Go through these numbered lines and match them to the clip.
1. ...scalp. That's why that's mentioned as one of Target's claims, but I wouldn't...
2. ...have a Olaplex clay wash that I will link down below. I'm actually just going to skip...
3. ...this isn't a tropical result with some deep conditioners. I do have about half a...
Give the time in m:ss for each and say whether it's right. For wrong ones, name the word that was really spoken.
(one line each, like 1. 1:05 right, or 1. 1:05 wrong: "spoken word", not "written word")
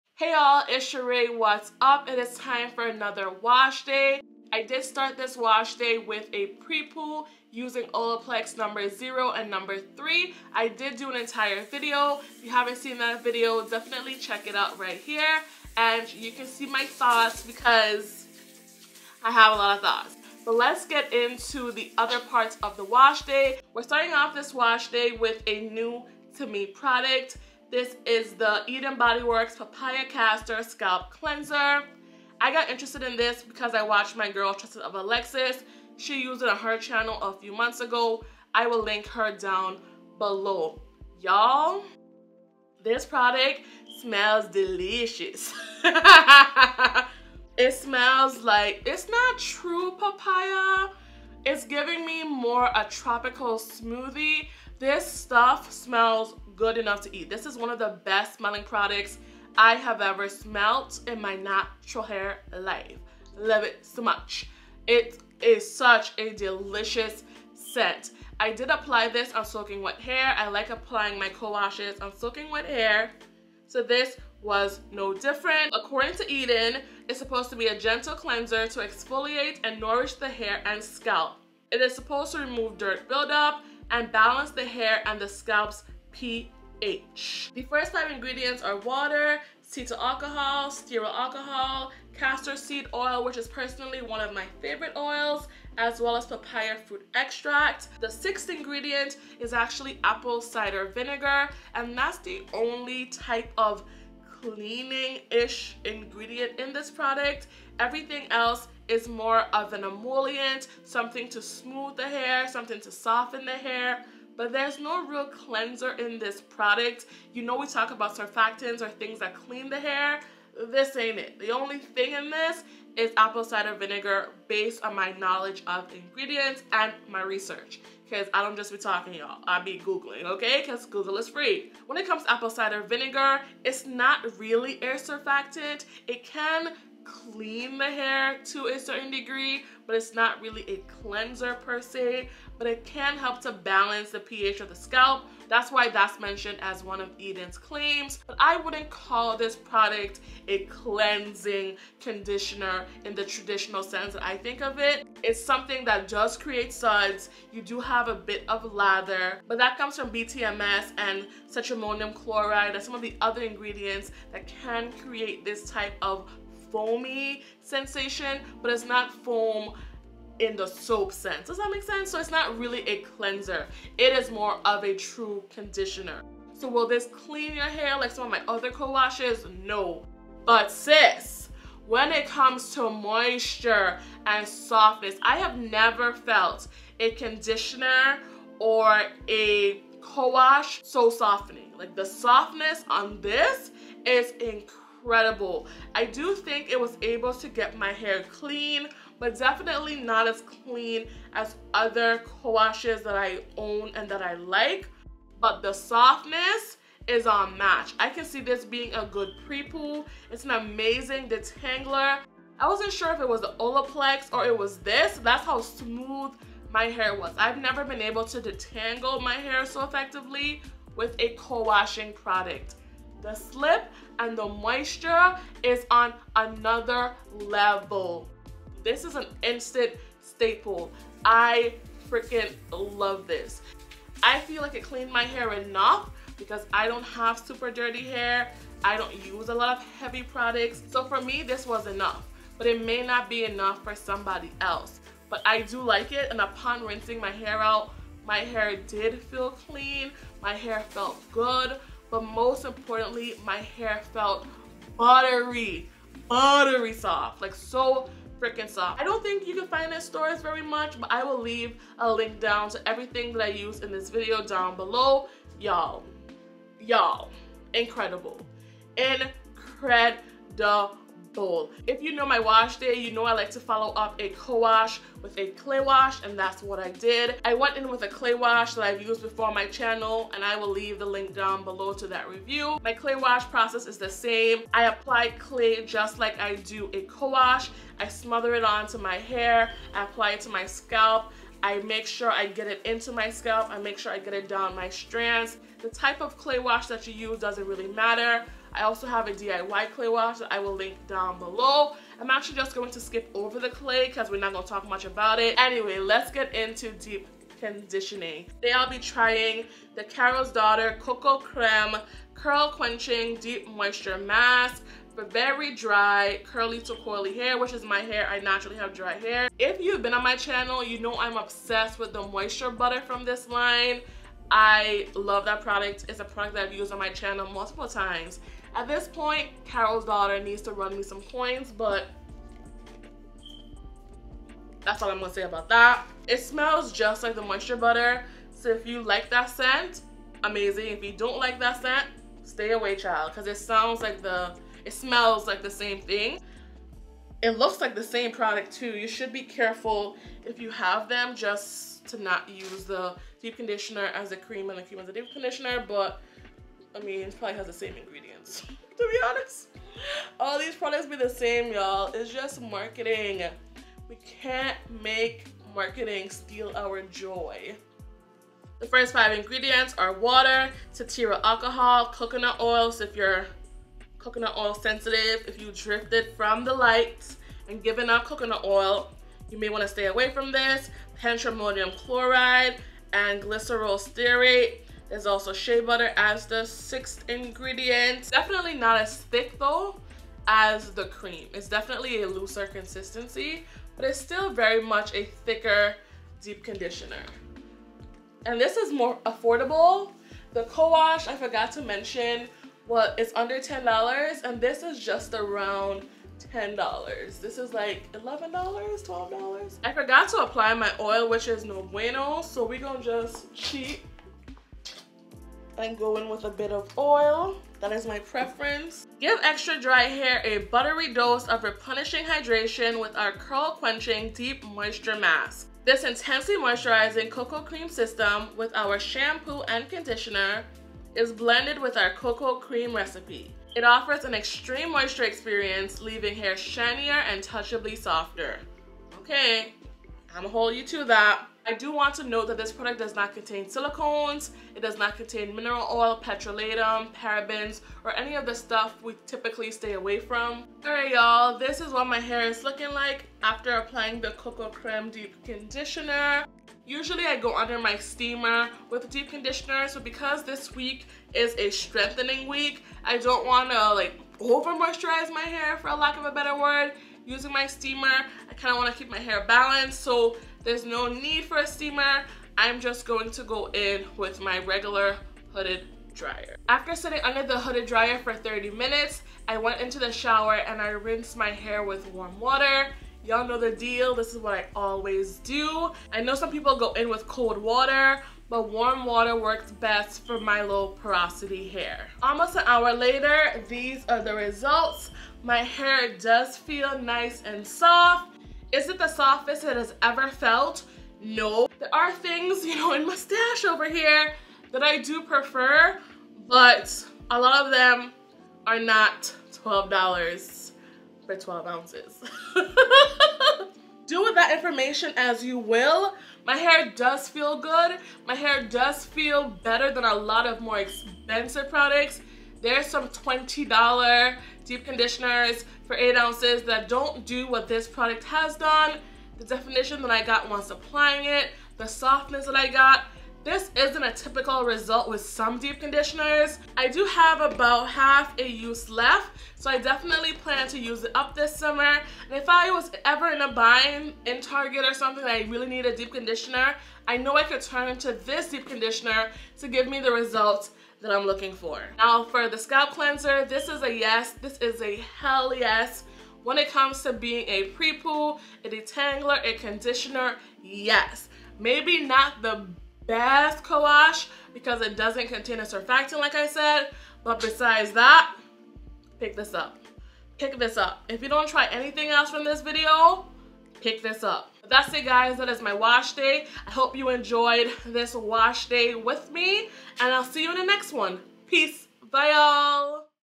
1. 2:24 wrong: "Eden", not "Target"
2. 4:59 wrong: "DIY", not "Olaplex"
3. 8:53 wrong: "typical", not "tropical".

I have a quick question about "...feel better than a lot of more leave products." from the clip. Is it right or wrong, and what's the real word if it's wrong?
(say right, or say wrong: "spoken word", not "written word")
wrong: "expensive", not "leave".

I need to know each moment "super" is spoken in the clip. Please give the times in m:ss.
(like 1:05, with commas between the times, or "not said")
3:57.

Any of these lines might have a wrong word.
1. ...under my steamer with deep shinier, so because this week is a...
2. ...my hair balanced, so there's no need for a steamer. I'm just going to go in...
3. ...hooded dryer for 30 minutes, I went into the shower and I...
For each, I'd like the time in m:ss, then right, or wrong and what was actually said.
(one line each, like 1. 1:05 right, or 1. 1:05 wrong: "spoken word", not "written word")
1. 7:37 wrong: "conditioner", not "shinier"
2. 7:49 right
3. 7:57 right.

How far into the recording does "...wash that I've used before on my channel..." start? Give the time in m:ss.
4:38.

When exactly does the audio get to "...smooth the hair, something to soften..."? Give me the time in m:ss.
1:51.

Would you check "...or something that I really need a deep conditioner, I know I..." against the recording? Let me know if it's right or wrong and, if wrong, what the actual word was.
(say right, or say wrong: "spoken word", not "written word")
right.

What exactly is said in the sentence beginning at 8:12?
Almost an hour later, these are the results.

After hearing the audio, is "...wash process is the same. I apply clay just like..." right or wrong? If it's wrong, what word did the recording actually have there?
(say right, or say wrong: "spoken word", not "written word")
right.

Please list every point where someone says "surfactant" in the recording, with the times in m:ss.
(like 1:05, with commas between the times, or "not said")
1:58, 2:14, 9:25.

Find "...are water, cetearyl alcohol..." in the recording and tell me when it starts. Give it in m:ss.
6:09.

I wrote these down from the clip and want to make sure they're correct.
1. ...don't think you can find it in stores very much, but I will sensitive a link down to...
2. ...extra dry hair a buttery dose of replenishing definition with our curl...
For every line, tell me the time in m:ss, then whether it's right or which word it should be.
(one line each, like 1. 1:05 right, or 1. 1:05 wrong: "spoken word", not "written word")
1. 4:19 wrong: "leave", not "sensitive"
2. 6:59 wrong: "hydration", not "definition".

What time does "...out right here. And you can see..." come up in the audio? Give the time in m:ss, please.
0:14.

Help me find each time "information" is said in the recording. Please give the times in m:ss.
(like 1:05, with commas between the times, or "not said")
8:34.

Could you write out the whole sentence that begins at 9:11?
Now for the scalp cleanser, this is a yes.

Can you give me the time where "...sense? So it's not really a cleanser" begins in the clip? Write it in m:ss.
2:51.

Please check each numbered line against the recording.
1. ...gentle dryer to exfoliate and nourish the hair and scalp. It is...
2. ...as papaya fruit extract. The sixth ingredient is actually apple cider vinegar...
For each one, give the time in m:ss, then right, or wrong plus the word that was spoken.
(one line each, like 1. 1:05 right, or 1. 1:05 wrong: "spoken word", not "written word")
1. 1:17 wrong: "cleanser", not "dryer"
2. 1:36 right.